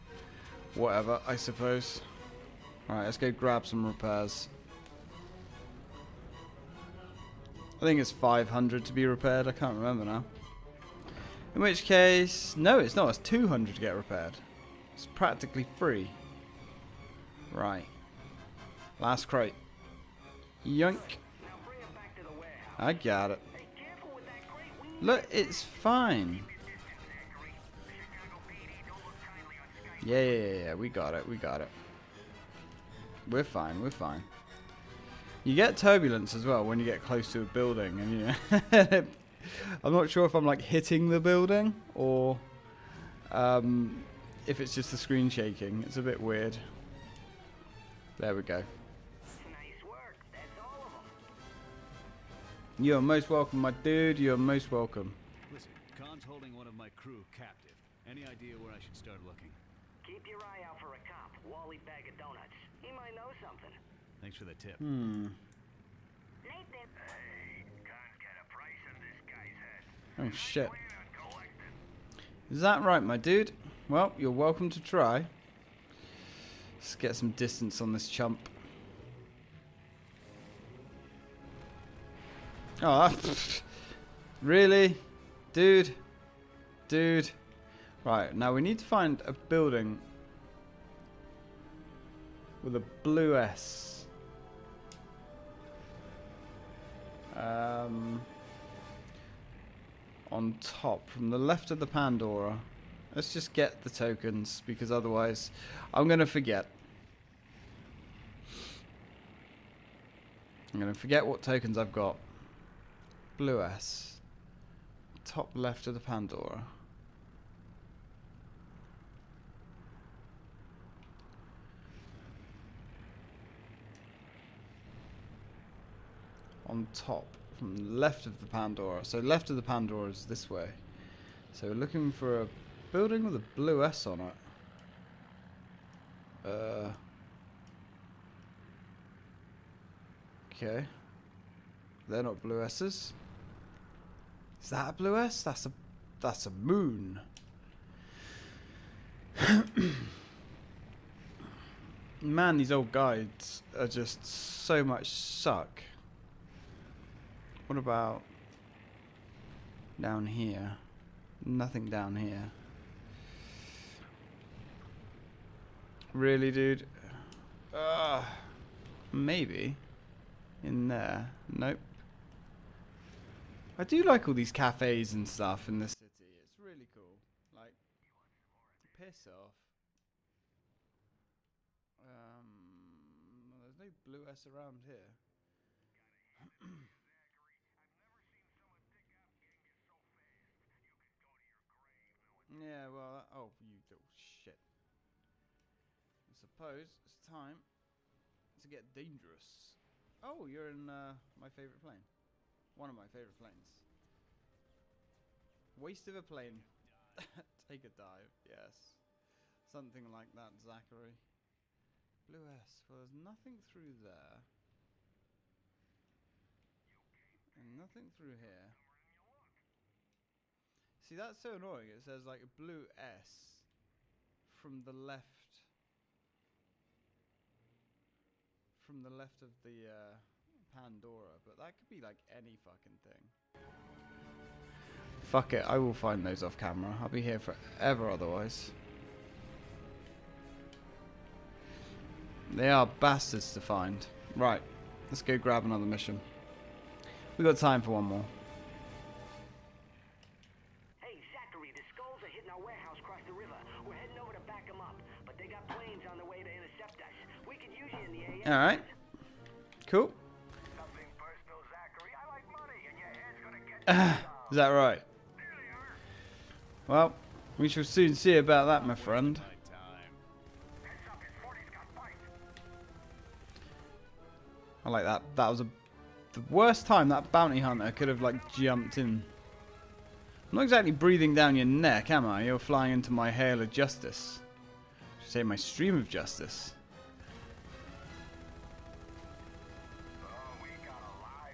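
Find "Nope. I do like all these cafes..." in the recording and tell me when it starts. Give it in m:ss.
2:51.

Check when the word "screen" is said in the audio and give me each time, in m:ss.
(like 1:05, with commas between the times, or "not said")
0:44.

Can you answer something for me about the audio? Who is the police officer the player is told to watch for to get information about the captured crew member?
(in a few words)
Wally Bag of Donuts.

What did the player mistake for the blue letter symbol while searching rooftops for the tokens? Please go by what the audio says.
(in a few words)
A moon.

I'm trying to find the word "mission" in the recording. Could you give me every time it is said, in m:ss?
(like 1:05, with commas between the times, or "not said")
4:05.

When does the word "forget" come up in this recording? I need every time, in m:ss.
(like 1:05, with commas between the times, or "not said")
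1:46, 1:50.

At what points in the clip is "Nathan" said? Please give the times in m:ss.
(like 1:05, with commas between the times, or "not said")
1:06.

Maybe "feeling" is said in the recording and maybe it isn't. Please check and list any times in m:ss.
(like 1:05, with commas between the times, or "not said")
not said.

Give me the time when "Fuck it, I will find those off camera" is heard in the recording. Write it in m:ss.
3:55.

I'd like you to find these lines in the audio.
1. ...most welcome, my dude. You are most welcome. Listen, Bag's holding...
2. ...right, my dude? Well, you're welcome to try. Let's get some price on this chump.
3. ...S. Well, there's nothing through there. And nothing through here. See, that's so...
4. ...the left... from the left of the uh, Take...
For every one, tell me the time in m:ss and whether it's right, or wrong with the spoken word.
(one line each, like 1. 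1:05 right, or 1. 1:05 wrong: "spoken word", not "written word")
1. 0:53 wrong: "Khan", not "Bag"
2. 1:12 wrong: "distance", not "price"
3. 3:32 right
4. 3:44 wrong: "Pandora", not "Take".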